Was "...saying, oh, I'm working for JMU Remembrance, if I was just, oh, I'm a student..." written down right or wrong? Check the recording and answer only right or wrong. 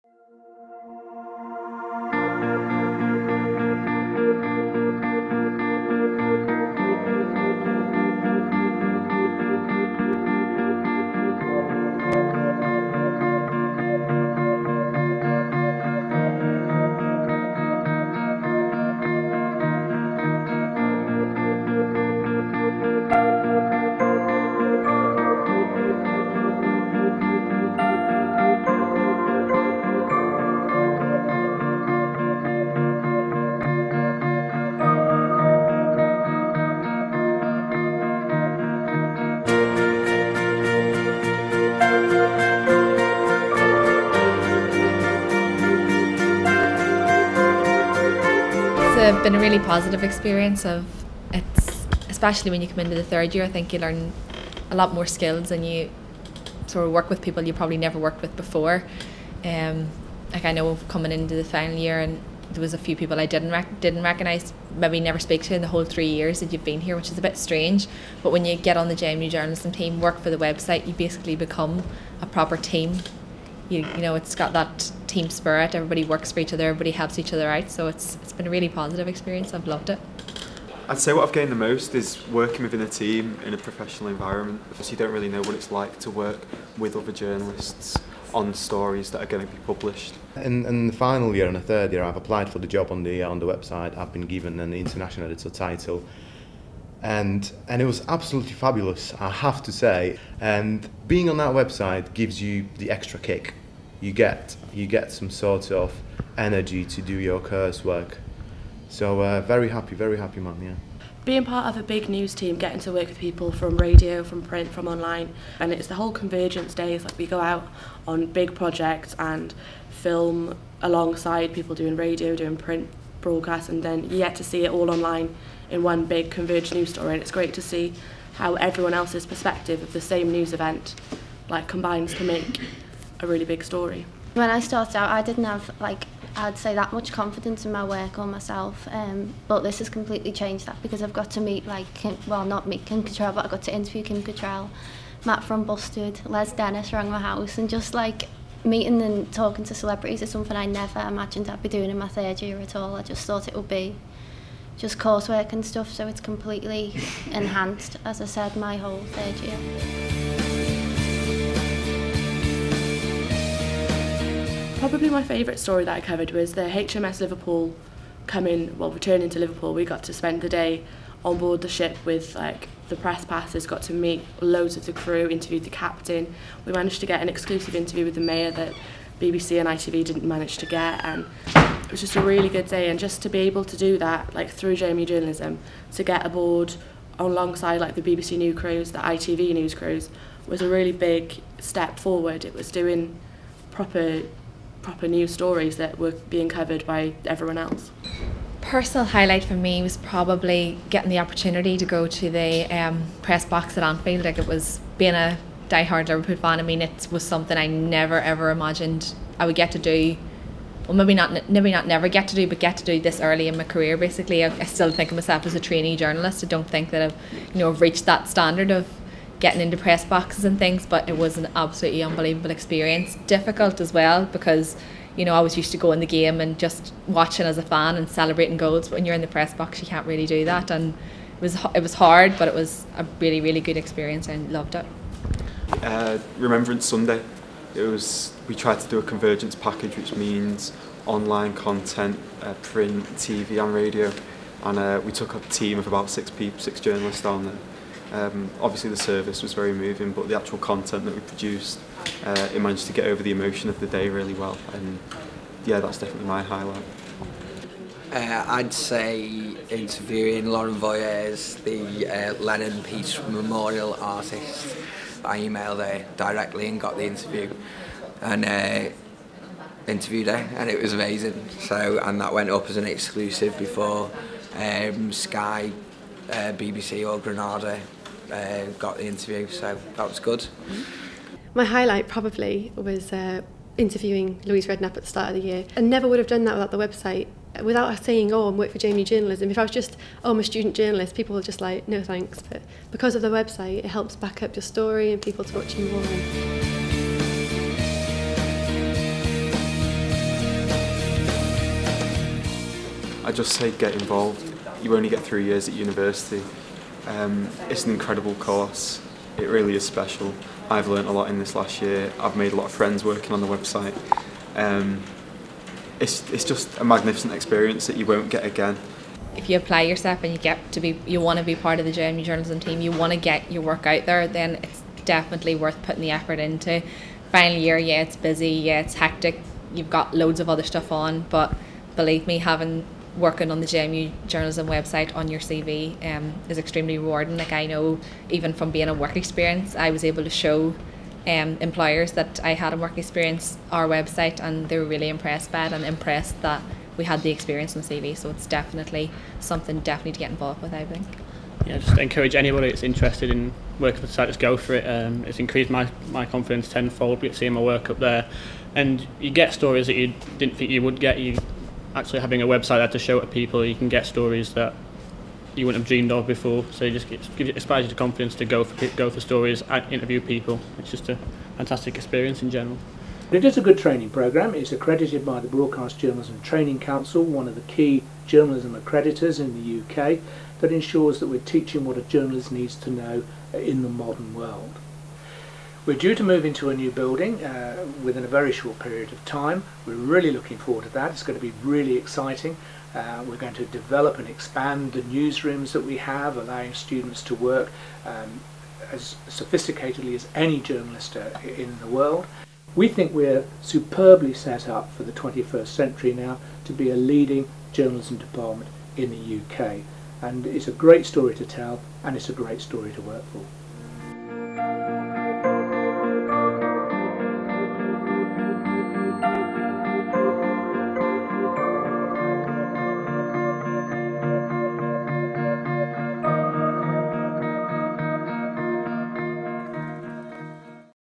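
wrong.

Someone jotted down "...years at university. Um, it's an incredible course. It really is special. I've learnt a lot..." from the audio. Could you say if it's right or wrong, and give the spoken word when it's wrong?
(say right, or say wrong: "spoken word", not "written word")
right.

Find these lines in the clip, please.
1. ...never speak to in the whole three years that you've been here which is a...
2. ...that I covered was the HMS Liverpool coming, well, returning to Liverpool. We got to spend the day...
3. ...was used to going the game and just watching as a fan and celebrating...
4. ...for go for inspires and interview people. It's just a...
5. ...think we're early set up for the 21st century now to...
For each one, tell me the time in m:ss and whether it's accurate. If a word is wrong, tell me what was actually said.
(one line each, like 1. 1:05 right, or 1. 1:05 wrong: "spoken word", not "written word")
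1. 1:04 right
2. 2:45 right
3. 3:45 right
4. 6:08 wrong: "stories", not "inspires"
5. 6:42 wrong: "superbly", not "early".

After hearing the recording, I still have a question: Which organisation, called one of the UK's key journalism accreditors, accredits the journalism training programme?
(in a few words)
Broadcast Journalism Training Council.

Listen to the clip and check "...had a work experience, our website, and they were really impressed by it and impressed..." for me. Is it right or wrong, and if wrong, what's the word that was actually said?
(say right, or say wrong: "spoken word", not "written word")
right.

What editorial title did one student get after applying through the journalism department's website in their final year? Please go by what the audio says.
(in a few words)
International editor.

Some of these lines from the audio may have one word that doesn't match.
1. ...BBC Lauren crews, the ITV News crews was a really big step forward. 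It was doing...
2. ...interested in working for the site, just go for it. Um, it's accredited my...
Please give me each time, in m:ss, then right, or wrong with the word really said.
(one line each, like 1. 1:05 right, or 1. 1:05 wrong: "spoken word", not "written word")
1. 3:08 wrong: "News", not "Lauren"
2. 5:52 wrong: "increased", not "accredited".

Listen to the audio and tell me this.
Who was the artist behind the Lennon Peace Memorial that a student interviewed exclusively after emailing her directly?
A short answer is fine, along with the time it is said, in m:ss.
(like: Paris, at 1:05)
Lauren Voiers, at 4:20.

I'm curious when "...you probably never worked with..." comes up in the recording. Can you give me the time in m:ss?
0:57.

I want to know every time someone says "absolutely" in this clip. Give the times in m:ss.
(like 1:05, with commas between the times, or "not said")
1:38, 3:41.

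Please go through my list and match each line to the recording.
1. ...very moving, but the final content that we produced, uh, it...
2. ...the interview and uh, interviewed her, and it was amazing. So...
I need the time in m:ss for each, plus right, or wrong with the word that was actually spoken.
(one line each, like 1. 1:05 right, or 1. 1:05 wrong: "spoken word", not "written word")
1. 4:09 wrong: "actual", not "final"
2. 4:26 right.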